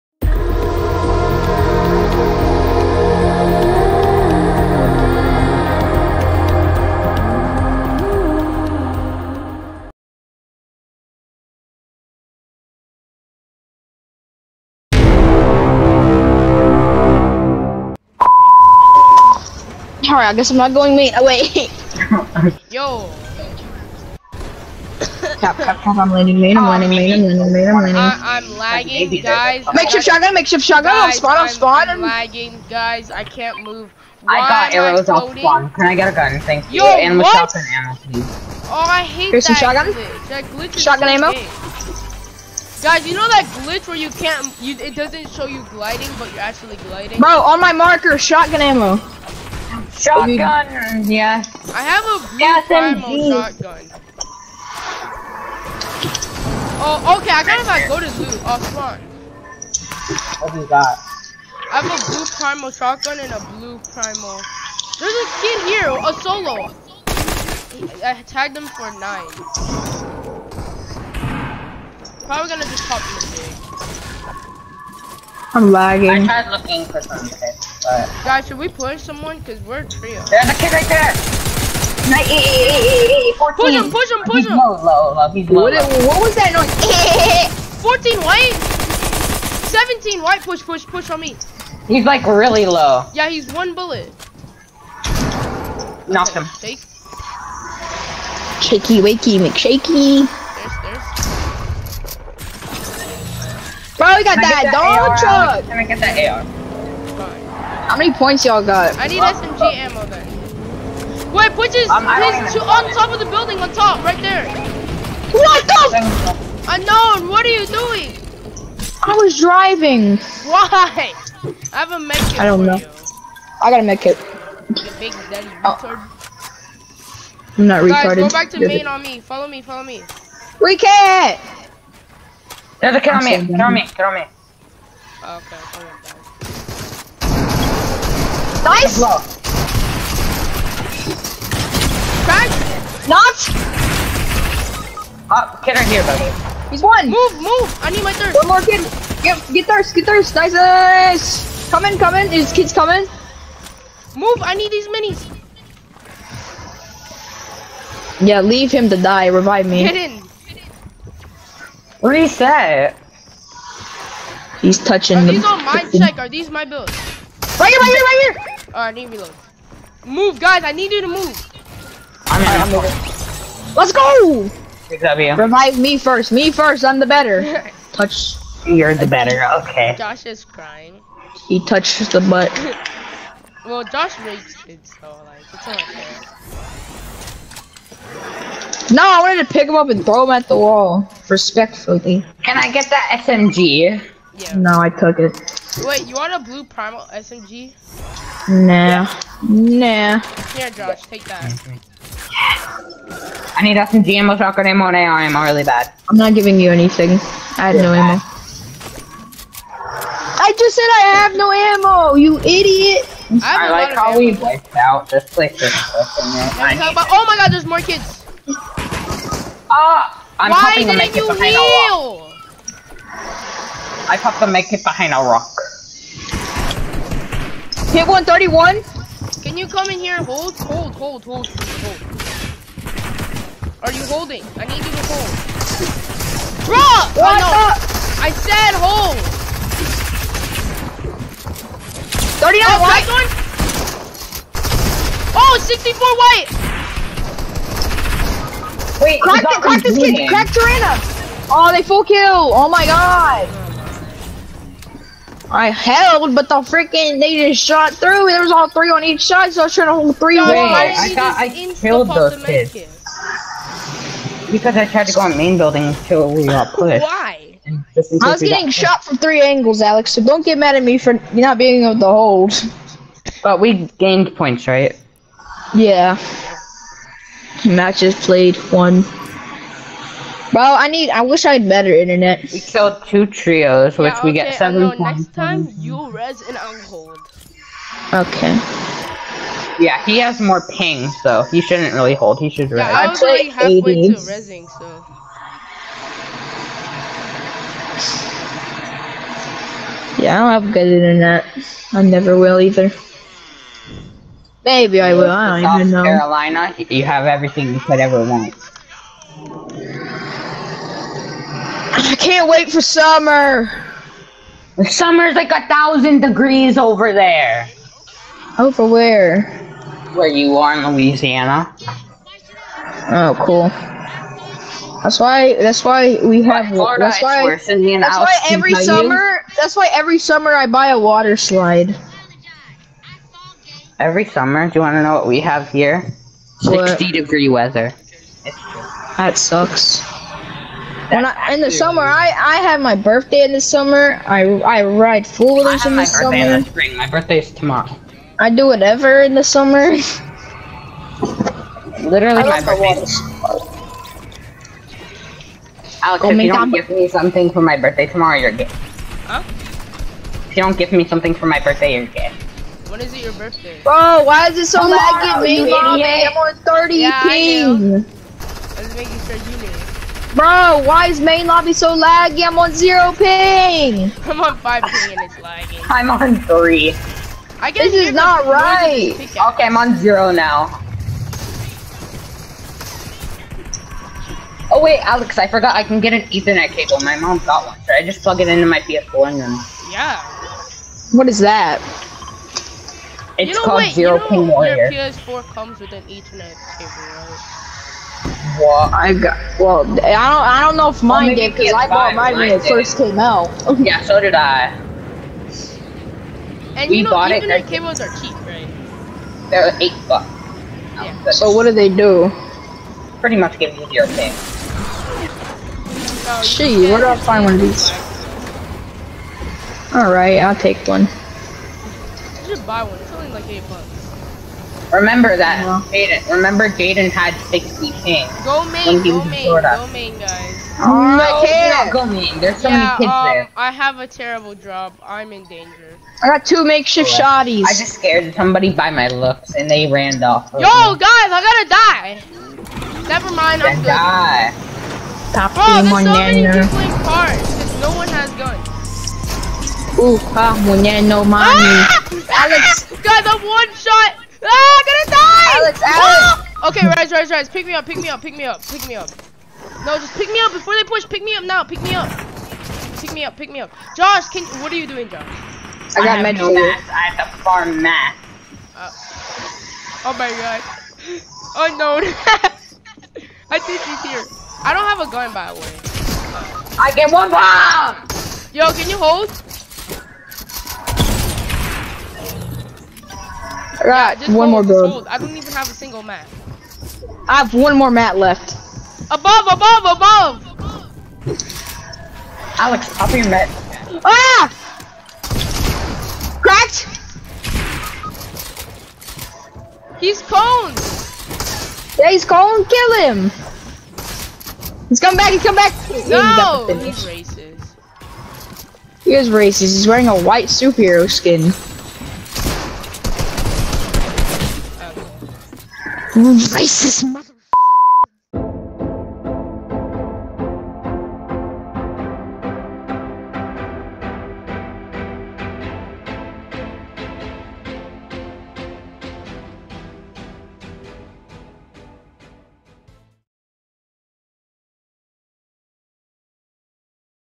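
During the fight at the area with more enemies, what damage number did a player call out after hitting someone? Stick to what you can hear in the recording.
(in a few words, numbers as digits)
131.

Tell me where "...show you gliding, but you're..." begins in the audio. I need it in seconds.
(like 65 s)
45 s.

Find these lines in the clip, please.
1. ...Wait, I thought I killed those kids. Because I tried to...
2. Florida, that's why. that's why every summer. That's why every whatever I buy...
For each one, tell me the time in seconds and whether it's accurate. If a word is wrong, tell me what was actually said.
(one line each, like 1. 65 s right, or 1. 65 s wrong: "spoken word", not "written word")
1. 260 s right
2. 326 s wrong: "summer", not "whatever".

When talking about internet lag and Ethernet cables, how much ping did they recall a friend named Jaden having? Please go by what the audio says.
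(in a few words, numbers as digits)
60.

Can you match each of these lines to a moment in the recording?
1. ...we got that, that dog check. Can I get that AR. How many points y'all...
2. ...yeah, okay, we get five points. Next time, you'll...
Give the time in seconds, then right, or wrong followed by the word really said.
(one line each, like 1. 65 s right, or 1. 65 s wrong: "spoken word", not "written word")
1. 104 s wrong: "truck", not "check"
2. 284 s wrong: "seven", not "five".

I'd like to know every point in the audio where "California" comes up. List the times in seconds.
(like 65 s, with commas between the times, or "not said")
not said.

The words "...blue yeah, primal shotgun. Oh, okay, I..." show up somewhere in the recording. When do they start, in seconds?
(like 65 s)
52 s.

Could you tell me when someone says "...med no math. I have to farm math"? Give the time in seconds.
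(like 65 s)
466 s.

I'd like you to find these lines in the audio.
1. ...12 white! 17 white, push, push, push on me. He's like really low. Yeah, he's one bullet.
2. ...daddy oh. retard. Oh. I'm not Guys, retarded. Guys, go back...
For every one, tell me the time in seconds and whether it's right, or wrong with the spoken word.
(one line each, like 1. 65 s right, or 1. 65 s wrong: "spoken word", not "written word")
1. 87 s wrong: "14", not "12"
2. 125 s right.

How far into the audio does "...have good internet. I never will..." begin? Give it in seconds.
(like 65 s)
300 s.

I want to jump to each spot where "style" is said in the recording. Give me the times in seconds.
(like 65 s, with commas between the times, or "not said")
not said.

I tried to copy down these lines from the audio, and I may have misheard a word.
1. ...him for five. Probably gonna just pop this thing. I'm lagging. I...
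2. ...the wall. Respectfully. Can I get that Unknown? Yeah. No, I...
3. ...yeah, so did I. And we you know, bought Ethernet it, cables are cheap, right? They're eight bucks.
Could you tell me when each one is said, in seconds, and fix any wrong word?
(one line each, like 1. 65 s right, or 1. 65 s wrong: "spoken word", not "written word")
1. 68 s wrong: "nine", not "five"
2. 190 s wrong: "SMG", not "Unknown"
3. 403 s right.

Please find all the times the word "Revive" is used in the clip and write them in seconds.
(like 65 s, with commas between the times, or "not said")
159 s, 175 s.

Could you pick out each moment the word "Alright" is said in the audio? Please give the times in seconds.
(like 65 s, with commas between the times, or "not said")
168 s, 419 s.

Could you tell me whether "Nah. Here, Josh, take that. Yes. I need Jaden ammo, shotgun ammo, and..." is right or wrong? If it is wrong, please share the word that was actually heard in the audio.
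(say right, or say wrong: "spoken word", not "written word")
wrong: "SMG", not "Jaden".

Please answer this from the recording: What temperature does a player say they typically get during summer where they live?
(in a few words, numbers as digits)
60 degrees.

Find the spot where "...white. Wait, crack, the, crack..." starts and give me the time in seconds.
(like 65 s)
246 s.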